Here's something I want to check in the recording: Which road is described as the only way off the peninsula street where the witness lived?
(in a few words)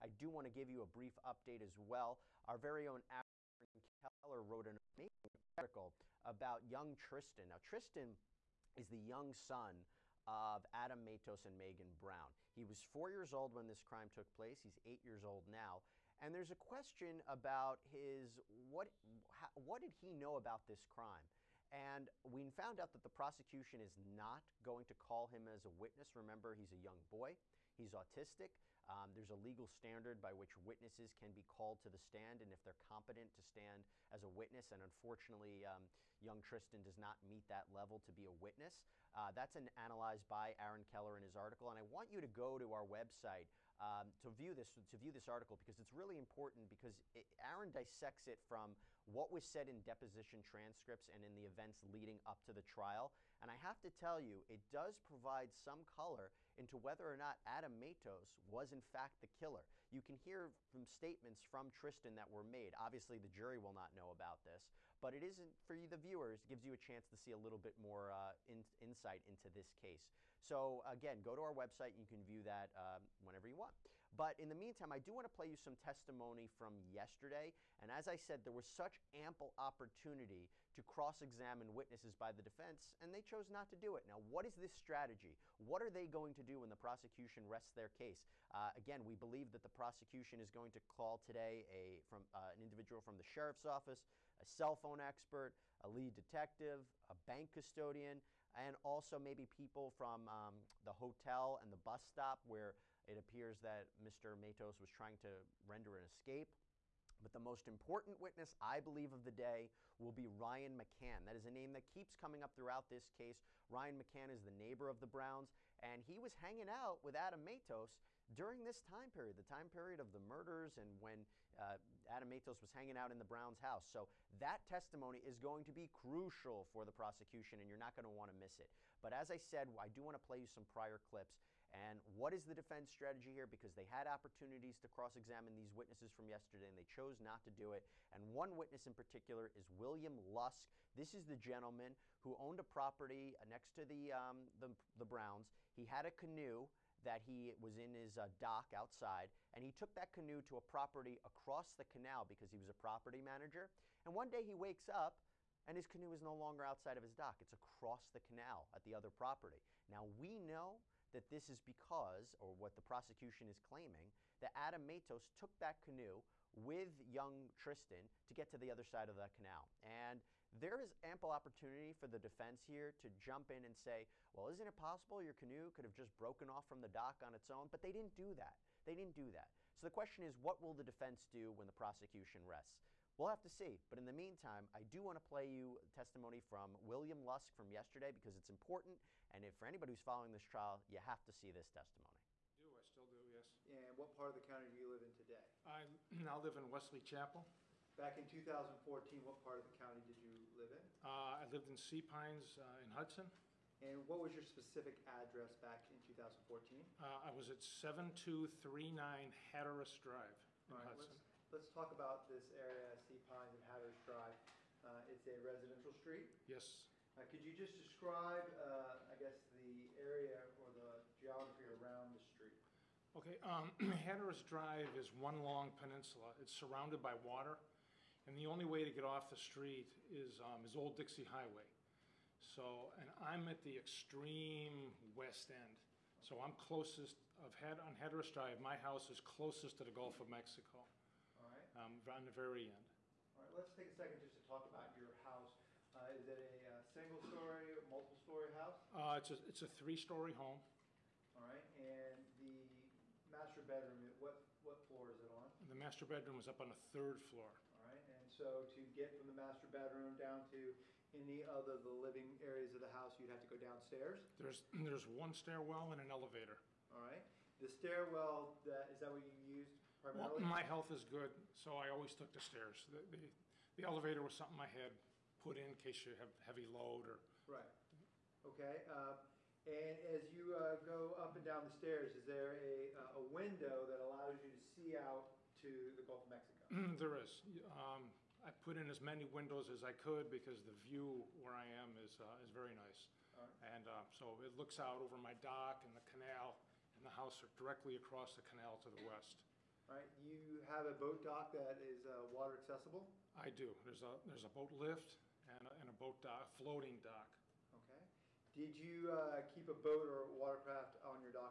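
Old Dixie Highway.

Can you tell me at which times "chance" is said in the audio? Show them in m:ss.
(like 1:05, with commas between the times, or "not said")
1:06.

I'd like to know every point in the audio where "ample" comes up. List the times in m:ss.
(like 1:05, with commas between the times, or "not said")
1:19, 2:51.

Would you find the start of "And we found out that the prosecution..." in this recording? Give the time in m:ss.
0:21.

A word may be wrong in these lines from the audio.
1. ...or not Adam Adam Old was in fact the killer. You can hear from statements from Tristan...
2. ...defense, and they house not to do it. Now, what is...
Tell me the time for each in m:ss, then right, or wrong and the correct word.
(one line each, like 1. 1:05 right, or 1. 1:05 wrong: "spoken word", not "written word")
1. 0:57 wrong: "Matos", not "Old"
2. 1:22 wrong: "chose", not "house".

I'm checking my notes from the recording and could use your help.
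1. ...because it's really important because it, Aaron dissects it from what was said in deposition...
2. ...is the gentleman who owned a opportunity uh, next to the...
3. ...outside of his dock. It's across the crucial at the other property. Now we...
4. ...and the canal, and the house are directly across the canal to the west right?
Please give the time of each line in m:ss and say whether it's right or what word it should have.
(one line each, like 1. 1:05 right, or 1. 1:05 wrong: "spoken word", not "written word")
1. 0:45 right
2. 2:21 wrong: "property", not "opportunity"
3. 2:36 wrong: "canal", not "crucial"
4. 4:55 right.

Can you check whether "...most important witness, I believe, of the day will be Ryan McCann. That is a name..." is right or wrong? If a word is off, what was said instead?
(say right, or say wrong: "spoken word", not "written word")
right.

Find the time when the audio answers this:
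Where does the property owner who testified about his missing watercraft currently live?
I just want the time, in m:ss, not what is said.
3:16.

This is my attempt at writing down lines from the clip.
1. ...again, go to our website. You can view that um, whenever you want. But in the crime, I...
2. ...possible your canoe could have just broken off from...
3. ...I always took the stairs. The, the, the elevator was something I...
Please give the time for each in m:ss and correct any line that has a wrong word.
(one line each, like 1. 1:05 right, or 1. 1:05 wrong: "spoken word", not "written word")
1. 1:10 wrong: "meantime", not "crime"
2. 2:54 right
3. 4:31 right.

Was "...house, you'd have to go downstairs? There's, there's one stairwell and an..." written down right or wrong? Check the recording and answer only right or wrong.
right.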